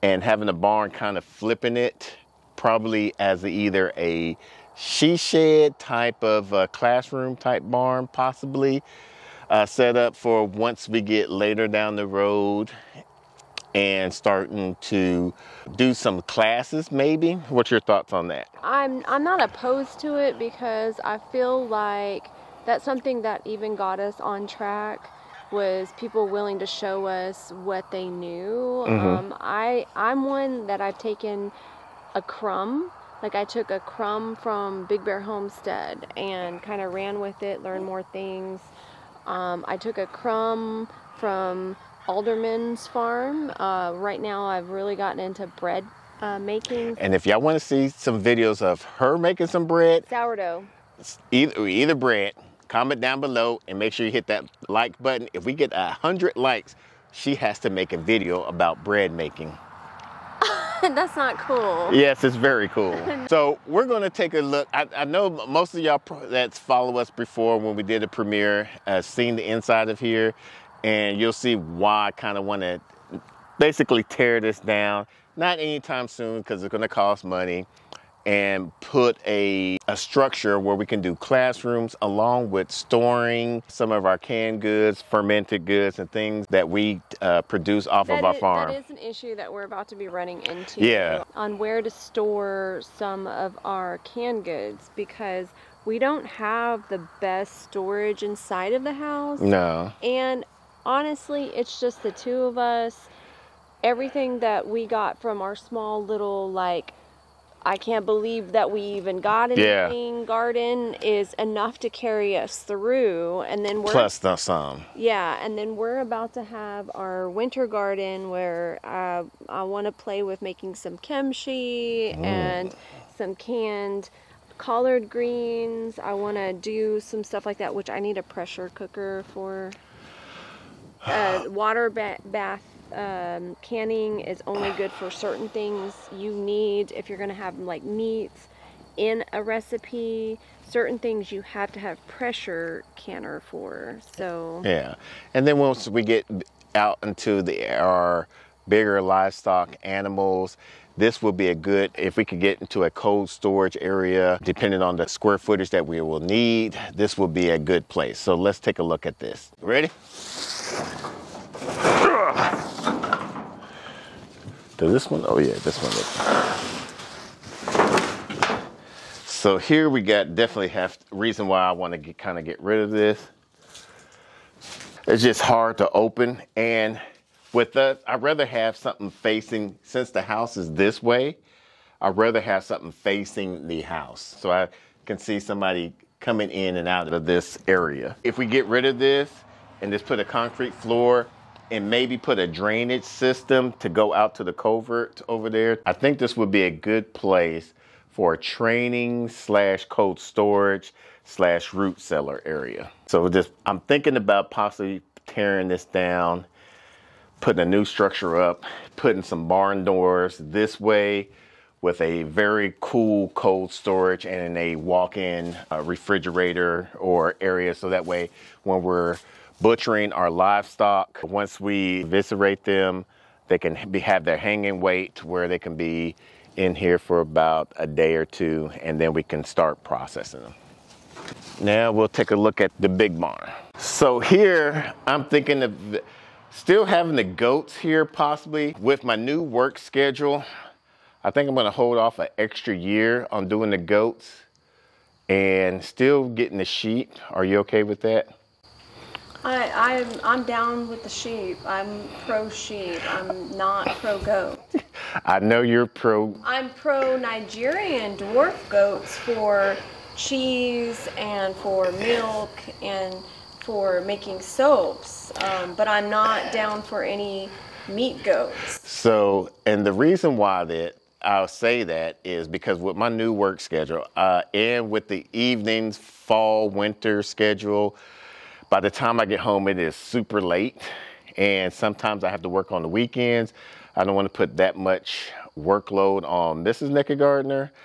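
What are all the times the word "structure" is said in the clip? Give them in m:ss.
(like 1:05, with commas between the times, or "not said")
1:19, 3:27.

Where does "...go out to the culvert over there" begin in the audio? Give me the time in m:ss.
3:13.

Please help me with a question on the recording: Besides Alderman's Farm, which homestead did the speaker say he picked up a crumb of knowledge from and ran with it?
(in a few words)
Big Bear Homestead.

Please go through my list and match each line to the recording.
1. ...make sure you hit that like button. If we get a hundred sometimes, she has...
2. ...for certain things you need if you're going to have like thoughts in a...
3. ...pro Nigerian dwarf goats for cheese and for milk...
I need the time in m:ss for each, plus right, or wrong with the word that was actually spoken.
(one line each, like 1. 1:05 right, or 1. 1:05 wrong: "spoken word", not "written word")
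1. 0:53 wrong: "likes", not "sometimes"
2. 2:14 wrong: "meats", not "thoughts"
3. 4:16 right.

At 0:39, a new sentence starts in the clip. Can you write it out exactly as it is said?
Um, I took a crumb from Alderman's Farm.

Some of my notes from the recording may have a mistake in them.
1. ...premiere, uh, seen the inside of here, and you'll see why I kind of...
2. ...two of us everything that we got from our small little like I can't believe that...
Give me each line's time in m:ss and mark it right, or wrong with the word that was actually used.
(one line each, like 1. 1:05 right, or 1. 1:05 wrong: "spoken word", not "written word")
1. 1:08 right
2. 1:42 right.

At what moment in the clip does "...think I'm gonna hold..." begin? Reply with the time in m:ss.
4:01.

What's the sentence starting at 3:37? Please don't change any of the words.
So that way when we're butchering our livestock.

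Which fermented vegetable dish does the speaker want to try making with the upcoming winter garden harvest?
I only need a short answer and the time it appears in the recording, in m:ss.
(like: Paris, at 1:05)
kimchi, at 2:00.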